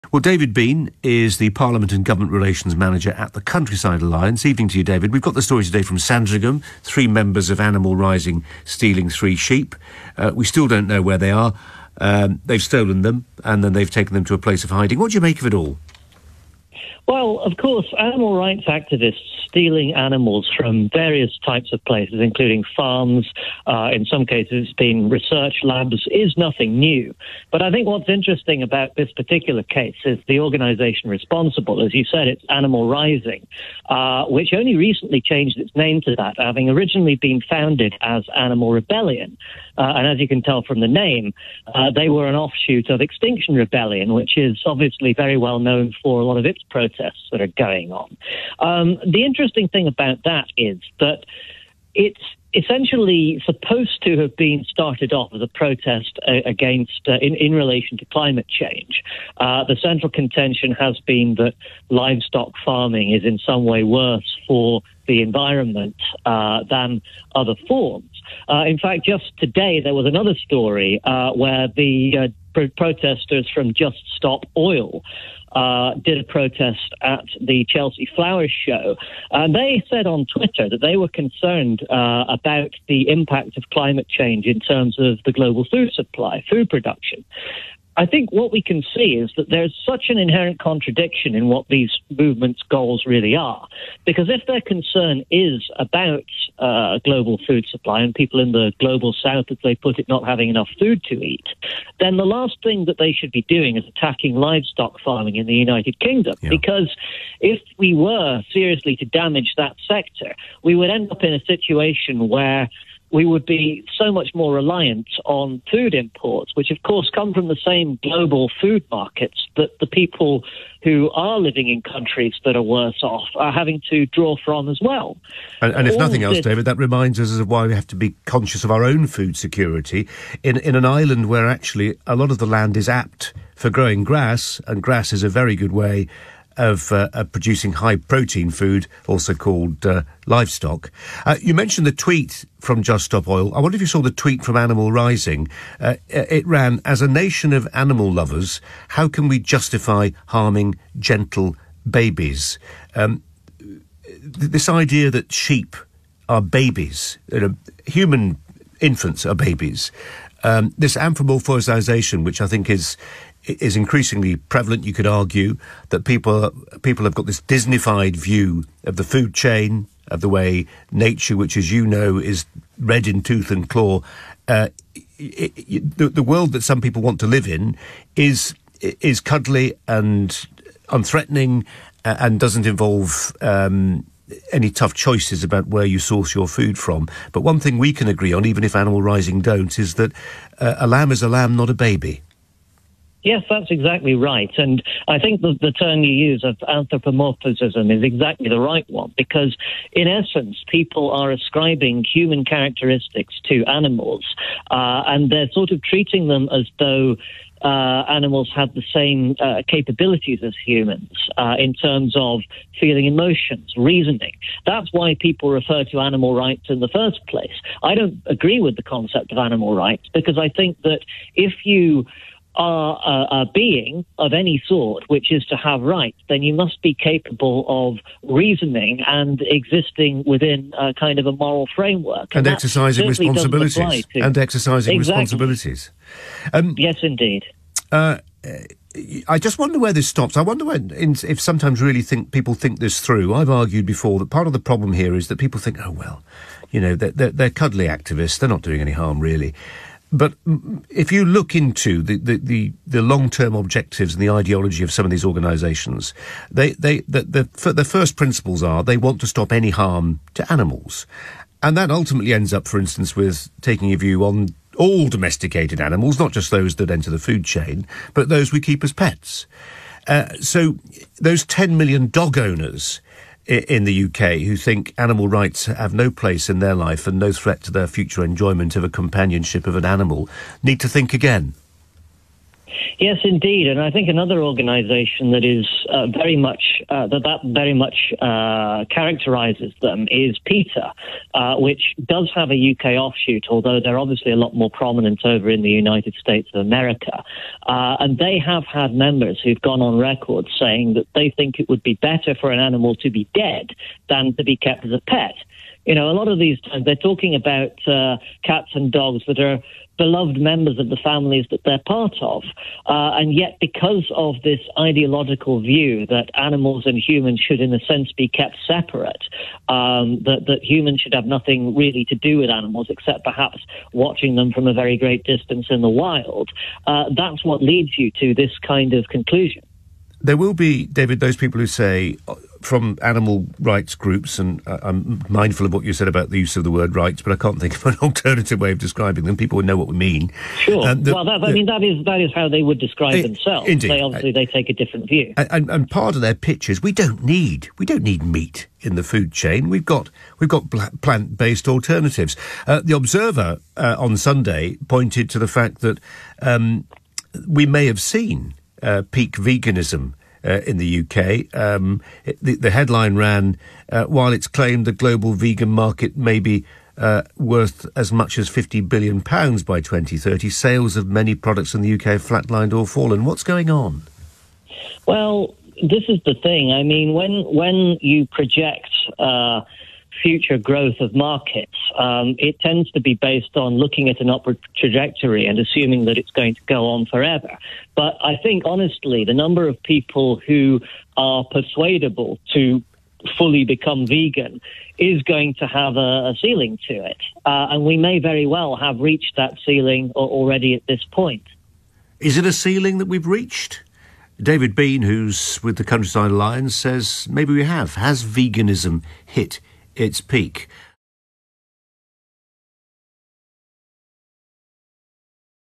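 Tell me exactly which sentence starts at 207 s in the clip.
Uh, animals have the same uh, capabilities as humans uh, in terms of feeling emotions, reasoning.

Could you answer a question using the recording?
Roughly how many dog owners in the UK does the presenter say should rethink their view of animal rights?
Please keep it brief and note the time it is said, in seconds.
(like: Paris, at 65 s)
10 million, at 271 s.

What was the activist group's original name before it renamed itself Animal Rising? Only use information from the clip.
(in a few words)
Animal Rebellion.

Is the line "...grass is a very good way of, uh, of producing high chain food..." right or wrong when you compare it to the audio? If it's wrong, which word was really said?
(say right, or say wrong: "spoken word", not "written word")
wrong: "protein", not "chain".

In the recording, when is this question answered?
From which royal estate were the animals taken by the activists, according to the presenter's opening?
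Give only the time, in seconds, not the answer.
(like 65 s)
5 s.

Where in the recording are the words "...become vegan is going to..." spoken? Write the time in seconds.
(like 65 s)
393 s.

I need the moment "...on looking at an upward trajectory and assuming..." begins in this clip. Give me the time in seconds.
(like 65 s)
383 s.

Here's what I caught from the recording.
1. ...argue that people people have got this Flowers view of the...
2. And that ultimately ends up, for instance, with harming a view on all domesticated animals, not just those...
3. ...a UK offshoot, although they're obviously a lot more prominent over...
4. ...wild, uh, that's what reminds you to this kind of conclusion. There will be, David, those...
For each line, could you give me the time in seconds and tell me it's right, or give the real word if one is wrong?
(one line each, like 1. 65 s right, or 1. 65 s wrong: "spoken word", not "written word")
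1. 165 s wrong: "Disneyfied", not "Flowers"
2. 261 s wrong: "taking", not "harming"
3. 292 s right
4. 326 s wrong: "leads", not "reminds".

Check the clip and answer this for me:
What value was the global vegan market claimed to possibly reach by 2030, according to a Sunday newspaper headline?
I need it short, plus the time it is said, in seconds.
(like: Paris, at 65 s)
£50 billion, at 368 s.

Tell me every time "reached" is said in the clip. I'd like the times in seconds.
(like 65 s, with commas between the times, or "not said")
398 s, 403 s.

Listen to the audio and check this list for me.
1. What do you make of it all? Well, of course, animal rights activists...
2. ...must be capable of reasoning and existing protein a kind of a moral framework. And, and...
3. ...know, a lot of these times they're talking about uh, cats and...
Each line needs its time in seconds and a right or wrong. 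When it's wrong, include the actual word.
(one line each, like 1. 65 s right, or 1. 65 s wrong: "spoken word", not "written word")
1. 14 s right
2. 226 s wrong: "within", not "protein"
3. 305 s right.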